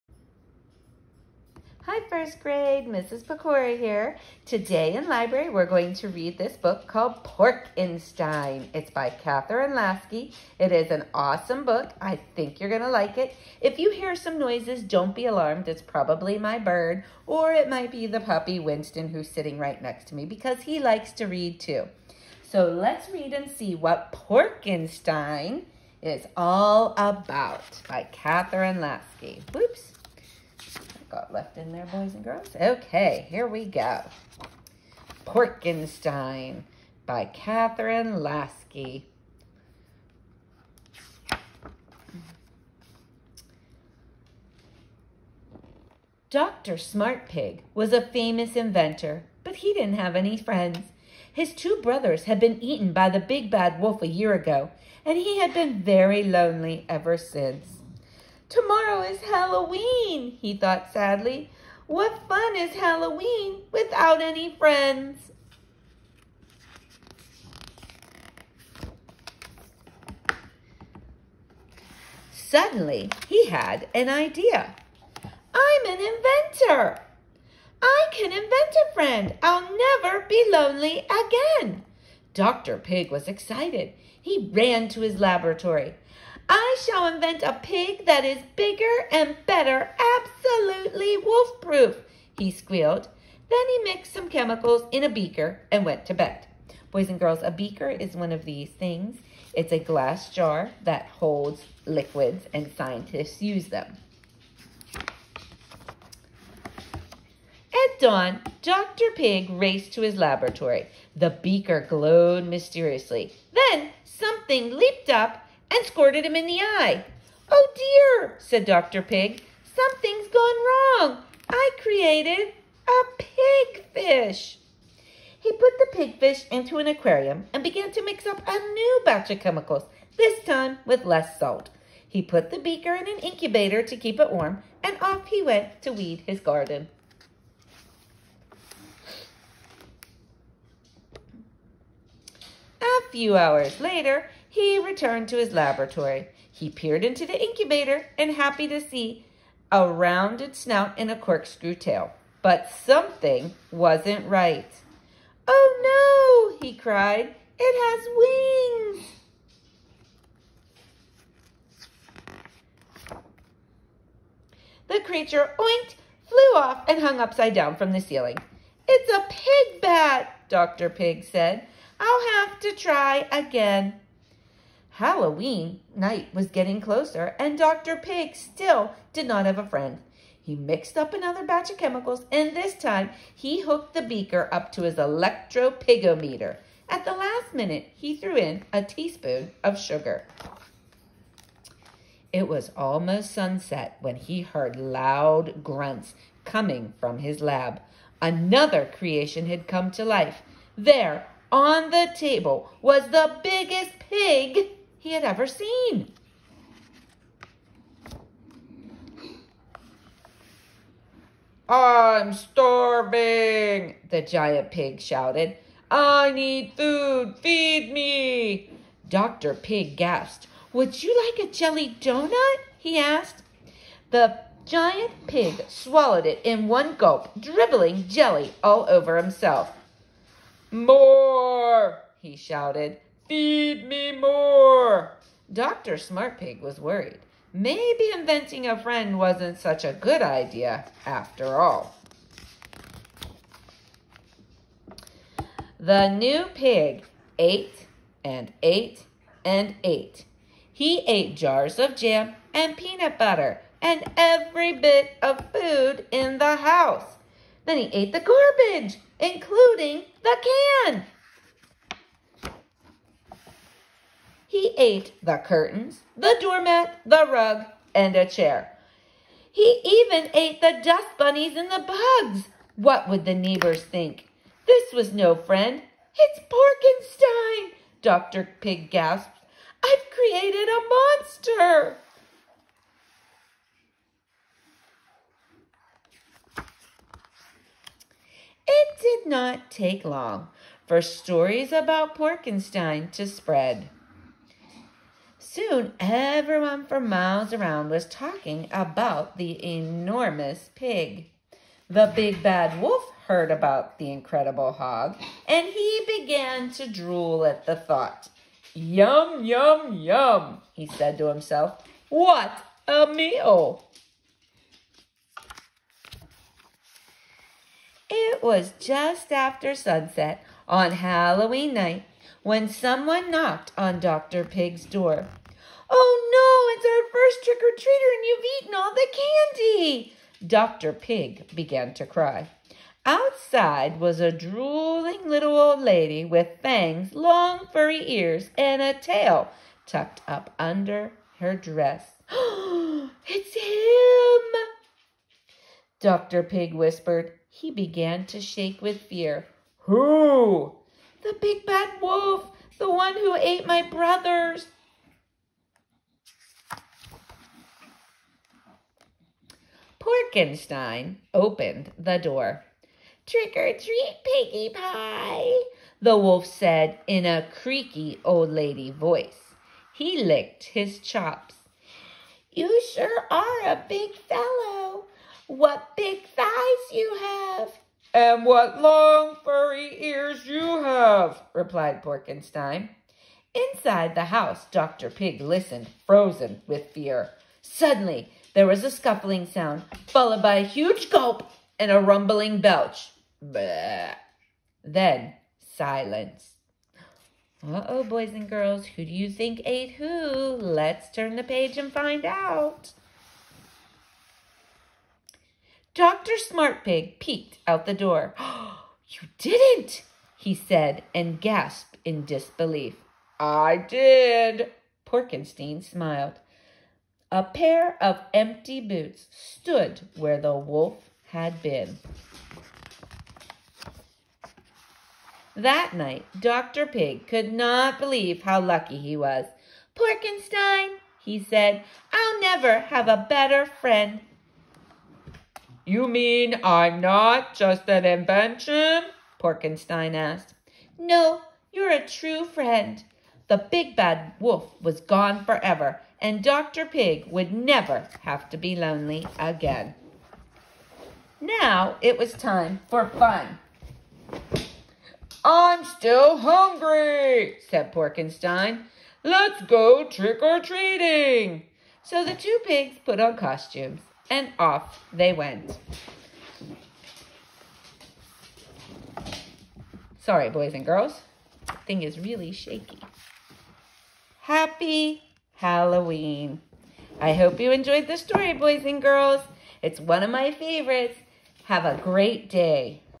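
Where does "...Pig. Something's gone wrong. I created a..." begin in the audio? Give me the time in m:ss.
1:59.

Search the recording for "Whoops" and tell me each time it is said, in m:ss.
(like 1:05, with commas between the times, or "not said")
0:29.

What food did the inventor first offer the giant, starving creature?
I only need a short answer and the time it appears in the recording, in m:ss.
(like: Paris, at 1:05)
jelly donut, at 3:41.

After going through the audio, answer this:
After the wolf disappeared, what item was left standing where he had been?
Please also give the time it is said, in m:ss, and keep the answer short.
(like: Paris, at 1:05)
a pair of empty boots, at 6:57.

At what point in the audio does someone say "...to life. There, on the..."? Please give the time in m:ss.
3:19.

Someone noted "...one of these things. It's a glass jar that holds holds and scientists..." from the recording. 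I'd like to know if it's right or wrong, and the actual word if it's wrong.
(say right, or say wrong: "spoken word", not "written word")
wrong: "liquids", not "holds".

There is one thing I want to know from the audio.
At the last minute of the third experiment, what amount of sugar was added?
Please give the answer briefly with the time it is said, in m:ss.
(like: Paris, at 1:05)
a teaspoon, at 3:08.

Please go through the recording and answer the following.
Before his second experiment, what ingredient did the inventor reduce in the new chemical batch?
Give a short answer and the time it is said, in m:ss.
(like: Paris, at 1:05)
salt, at 2:11.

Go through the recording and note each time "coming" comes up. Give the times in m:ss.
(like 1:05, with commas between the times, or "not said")
3:16.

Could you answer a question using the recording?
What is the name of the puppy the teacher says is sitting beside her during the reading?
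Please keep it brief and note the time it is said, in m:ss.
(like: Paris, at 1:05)
Winston, at 0:18.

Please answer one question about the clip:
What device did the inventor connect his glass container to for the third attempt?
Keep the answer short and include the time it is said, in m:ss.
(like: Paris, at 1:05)
electropigometer, at 3:04.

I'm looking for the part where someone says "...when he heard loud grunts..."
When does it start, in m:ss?
3:14.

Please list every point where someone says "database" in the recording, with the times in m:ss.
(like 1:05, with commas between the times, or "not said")
not said.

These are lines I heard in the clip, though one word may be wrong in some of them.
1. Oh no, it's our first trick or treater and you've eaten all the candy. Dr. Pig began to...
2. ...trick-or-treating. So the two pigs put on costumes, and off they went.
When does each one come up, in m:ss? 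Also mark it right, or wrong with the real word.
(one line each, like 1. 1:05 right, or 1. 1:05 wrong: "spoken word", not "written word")
1. 5:25 right
2. 7:40 right.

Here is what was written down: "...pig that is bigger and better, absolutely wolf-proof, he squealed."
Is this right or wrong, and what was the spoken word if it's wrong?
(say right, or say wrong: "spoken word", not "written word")
right.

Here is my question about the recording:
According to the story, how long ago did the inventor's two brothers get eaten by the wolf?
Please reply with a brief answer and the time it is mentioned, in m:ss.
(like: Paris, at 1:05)
a year ago, at 0:54.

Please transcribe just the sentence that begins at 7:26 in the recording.
Pig would never have to be lonely again.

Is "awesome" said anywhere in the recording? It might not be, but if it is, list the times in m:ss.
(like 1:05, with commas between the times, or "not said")
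0:11.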